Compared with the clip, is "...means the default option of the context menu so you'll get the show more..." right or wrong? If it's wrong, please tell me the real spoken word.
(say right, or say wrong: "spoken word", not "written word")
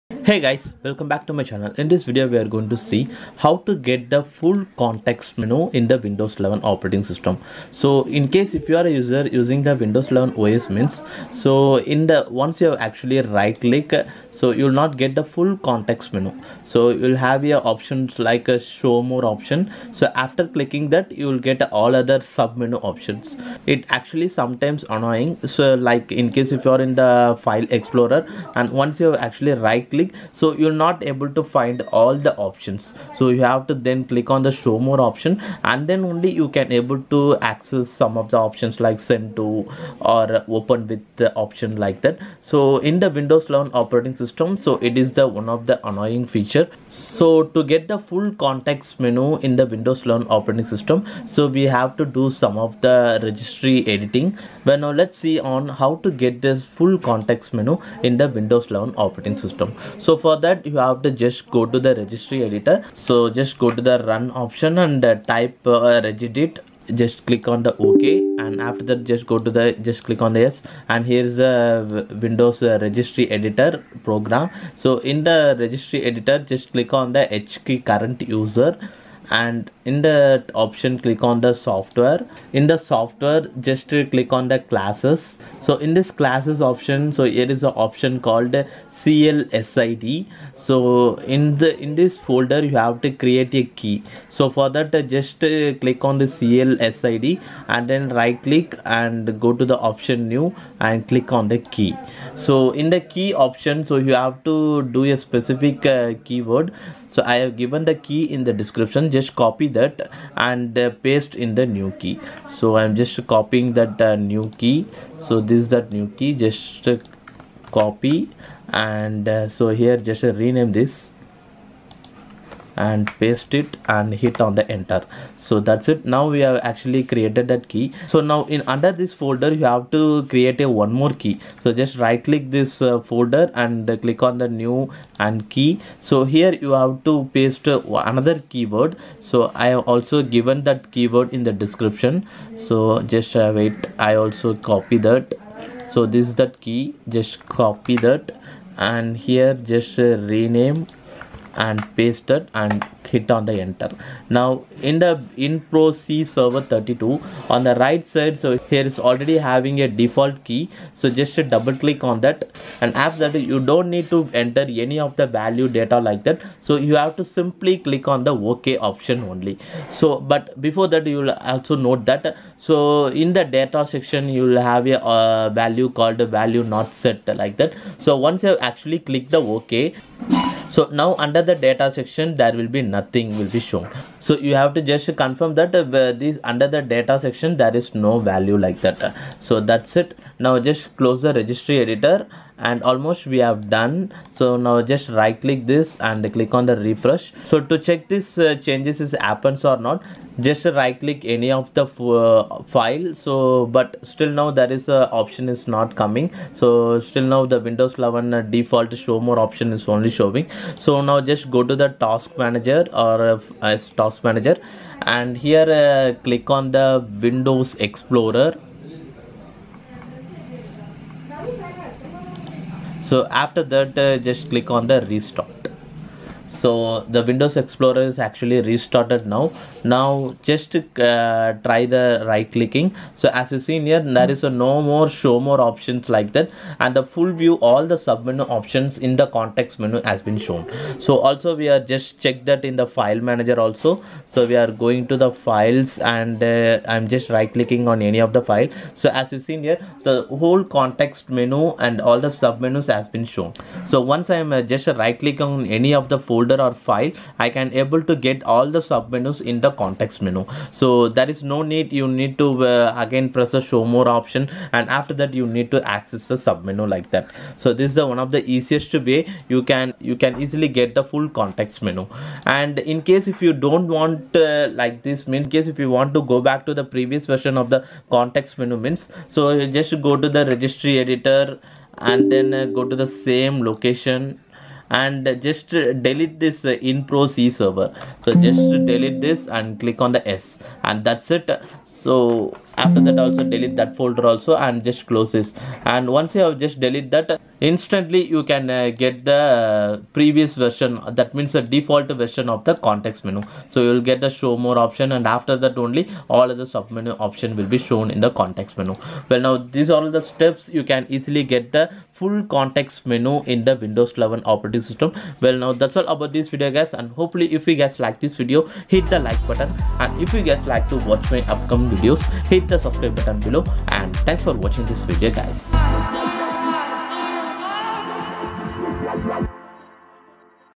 wrong: "version", not "option".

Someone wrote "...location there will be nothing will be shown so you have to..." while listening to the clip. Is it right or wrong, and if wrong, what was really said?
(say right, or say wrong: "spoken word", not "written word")
wrong: "section", not "location".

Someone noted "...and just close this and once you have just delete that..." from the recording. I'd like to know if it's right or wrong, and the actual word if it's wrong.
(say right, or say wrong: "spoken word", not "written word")
right.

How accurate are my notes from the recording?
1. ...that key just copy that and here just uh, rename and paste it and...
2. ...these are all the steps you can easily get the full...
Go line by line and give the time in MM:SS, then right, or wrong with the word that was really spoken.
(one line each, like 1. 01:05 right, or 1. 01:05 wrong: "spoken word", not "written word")
1. 02:26 right
2. 05:09 right.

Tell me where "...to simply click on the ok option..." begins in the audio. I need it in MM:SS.
02:47.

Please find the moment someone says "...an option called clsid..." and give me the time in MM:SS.
01:27.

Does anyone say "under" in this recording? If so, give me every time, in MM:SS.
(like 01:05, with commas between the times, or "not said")
02:08, 03:01, 03:06.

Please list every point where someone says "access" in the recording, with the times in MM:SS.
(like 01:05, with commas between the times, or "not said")
00:37, 04:25.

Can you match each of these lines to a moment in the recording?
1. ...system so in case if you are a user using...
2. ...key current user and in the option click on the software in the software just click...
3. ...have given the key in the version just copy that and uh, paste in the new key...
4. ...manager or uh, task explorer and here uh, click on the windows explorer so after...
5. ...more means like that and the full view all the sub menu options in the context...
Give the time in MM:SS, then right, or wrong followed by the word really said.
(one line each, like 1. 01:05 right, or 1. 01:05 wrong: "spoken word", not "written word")
1. 00:07 right
2. 01:17 right
3. 01:47 wrong: "description", not "version"
4. 03:32 wrong: "manager", not "explorer"
5. 03:55 wrong: "options", not "means".